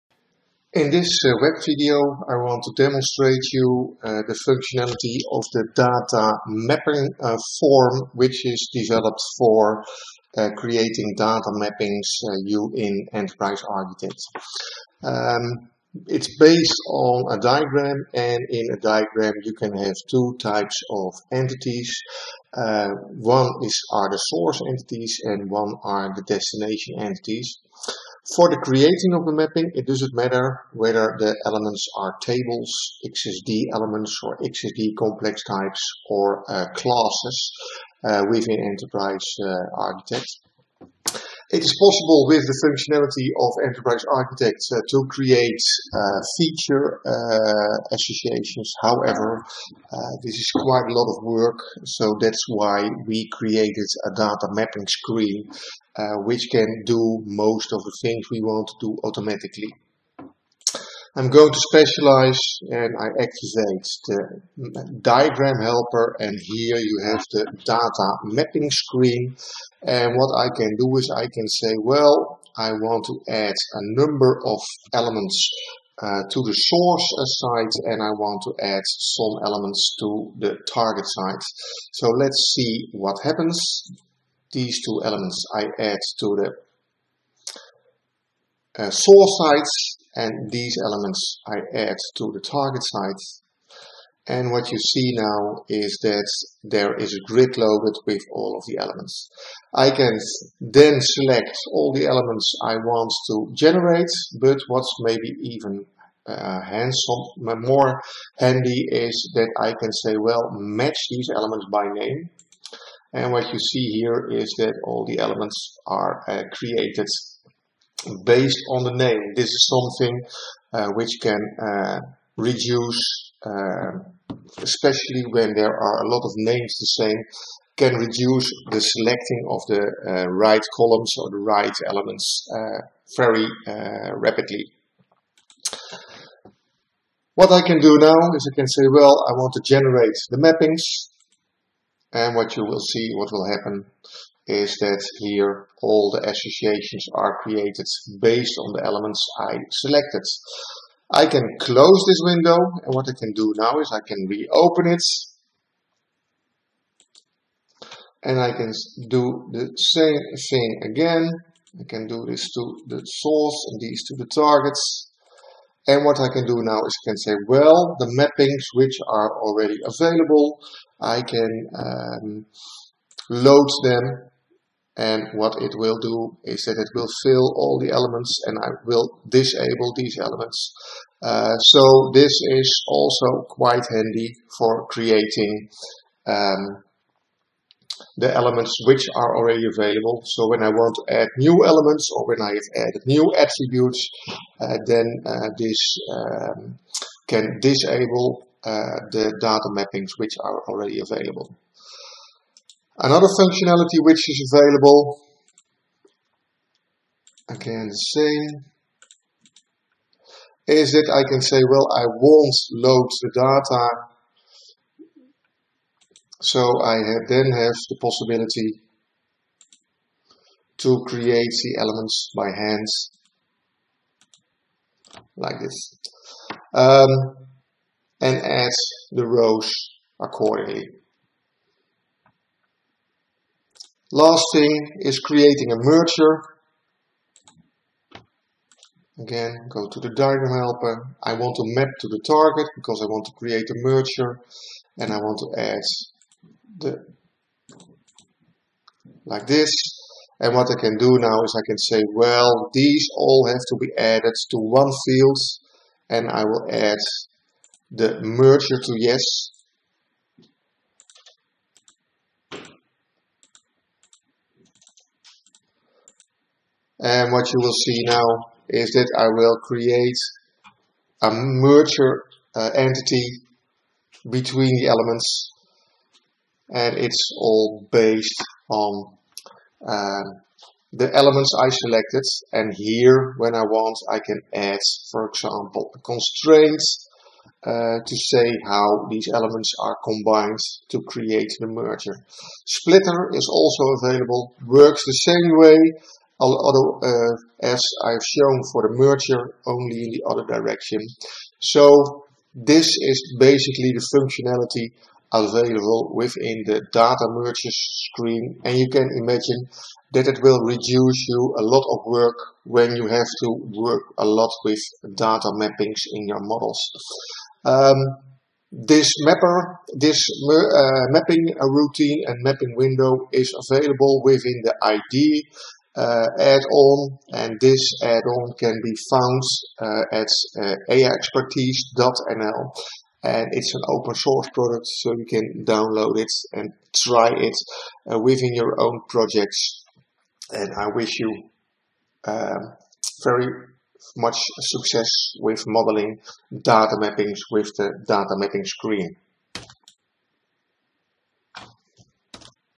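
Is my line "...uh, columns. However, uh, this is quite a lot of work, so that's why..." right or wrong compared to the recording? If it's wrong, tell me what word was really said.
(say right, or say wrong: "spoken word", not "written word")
wrong: "associations", not "columns".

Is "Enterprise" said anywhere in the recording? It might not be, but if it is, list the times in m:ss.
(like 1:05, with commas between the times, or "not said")
0:13, 0:38, 0:43.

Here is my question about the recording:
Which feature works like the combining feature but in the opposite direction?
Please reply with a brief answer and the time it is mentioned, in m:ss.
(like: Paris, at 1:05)
Splitter, at 4:52.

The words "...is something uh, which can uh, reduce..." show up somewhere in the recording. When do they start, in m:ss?
1:59.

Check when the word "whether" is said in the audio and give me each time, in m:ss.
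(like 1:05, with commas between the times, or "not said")
0:30.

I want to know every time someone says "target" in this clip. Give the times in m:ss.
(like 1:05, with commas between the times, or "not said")
1:20, 1:32, 2:44, 4:02.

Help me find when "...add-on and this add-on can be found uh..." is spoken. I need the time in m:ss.
5:26.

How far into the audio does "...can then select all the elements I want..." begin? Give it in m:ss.
1:39.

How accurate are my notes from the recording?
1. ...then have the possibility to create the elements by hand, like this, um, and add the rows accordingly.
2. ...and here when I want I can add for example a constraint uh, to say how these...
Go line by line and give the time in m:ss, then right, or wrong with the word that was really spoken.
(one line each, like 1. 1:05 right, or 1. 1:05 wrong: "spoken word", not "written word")
1. 3:37 right
2. 4:42 right.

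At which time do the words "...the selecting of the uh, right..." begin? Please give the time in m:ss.
2:08.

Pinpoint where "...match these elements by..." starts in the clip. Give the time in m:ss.
1:50.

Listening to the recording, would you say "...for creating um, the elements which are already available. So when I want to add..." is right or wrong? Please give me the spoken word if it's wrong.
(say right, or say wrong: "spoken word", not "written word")
right.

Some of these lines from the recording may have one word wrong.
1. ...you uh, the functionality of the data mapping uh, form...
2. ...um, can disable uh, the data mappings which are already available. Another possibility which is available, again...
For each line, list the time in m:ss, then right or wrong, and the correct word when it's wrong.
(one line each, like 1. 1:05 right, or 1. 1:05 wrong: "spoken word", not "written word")
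1. 0:03 right
2. 3:16 wrong: "functionality", not "possibility".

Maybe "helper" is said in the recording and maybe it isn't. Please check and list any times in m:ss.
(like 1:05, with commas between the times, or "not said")
1:05, 4:00.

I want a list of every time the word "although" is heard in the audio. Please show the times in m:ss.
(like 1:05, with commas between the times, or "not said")
4:56.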